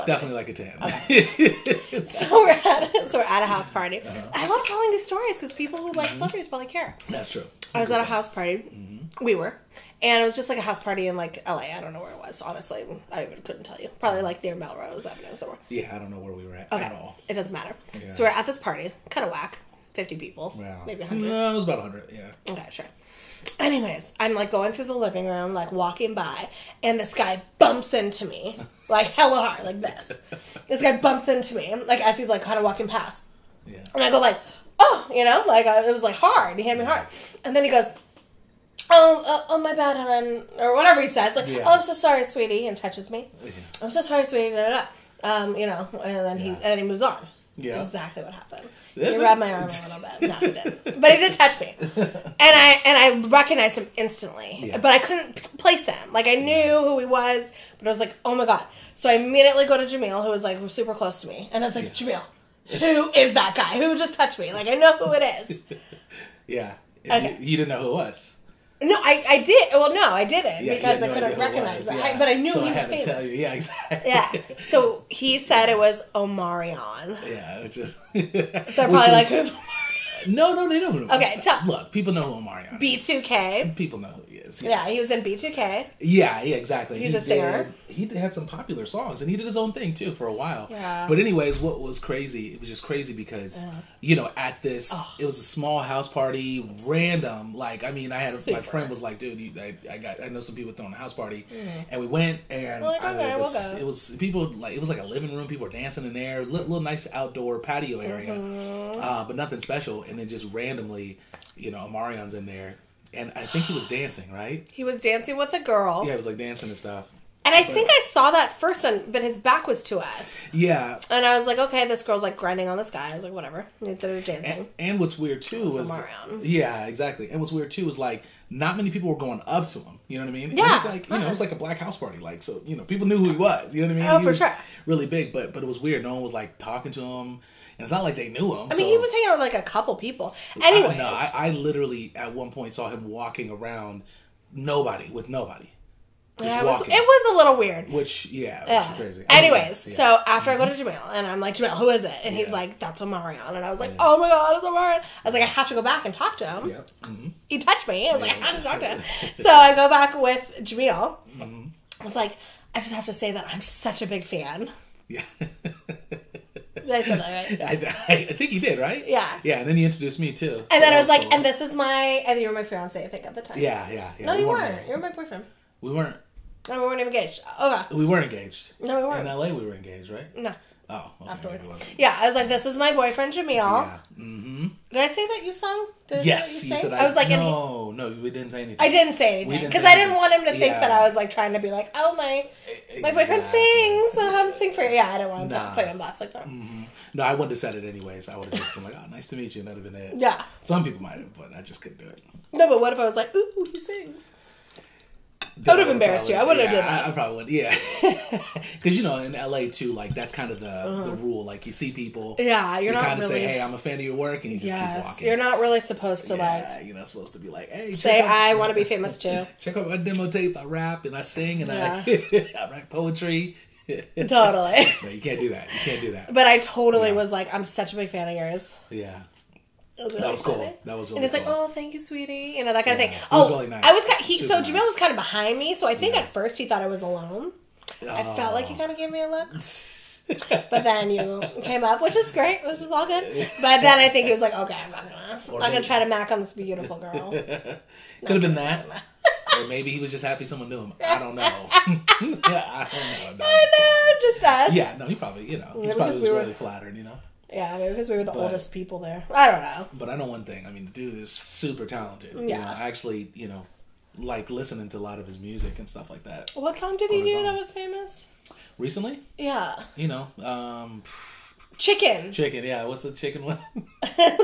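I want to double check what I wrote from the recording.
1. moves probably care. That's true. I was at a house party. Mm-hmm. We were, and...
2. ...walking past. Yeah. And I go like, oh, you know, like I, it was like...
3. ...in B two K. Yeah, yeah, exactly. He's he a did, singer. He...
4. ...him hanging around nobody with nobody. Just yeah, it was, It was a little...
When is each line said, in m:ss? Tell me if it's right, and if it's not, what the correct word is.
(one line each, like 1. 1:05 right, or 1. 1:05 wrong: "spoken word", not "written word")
1. 0:06 wrong: "celebrities", not "moves"
2. 0:32 right
3. 1:25 right
4. 2:22 wrong: "walking", not "hanging".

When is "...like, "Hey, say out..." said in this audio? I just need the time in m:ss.
3:37.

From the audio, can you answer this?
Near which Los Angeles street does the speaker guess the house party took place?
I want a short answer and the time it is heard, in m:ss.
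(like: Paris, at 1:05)
Melrose Avenue, at 0:14.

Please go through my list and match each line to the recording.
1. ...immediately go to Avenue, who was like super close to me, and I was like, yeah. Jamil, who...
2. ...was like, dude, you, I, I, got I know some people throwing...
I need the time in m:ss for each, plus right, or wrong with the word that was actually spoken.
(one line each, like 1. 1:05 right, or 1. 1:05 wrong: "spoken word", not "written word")
1. 0:59 wrong: "Jamil", not "Avenue"
2. 1:38 right.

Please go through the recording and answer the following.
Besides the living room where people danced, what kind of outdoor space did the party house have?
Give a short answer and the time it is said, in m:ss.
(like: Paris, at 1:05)
Patio, at 1:47.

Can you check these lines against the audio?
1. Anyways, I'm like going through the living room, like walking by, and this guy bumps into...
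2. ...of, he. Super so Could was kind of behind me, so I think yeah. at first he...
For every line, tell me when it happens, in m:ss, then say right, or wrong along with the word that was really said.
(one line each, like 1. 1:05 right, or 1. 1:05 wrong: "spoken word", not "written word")
1. 0:23 right
2. 3:54 wrong: "Jamil", not "Could".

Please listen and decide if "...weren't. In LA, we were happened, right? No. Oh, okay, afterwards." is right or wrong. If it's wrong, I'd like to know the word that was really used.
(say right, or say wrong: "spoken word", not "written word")
wrong: "engaged", not "happened".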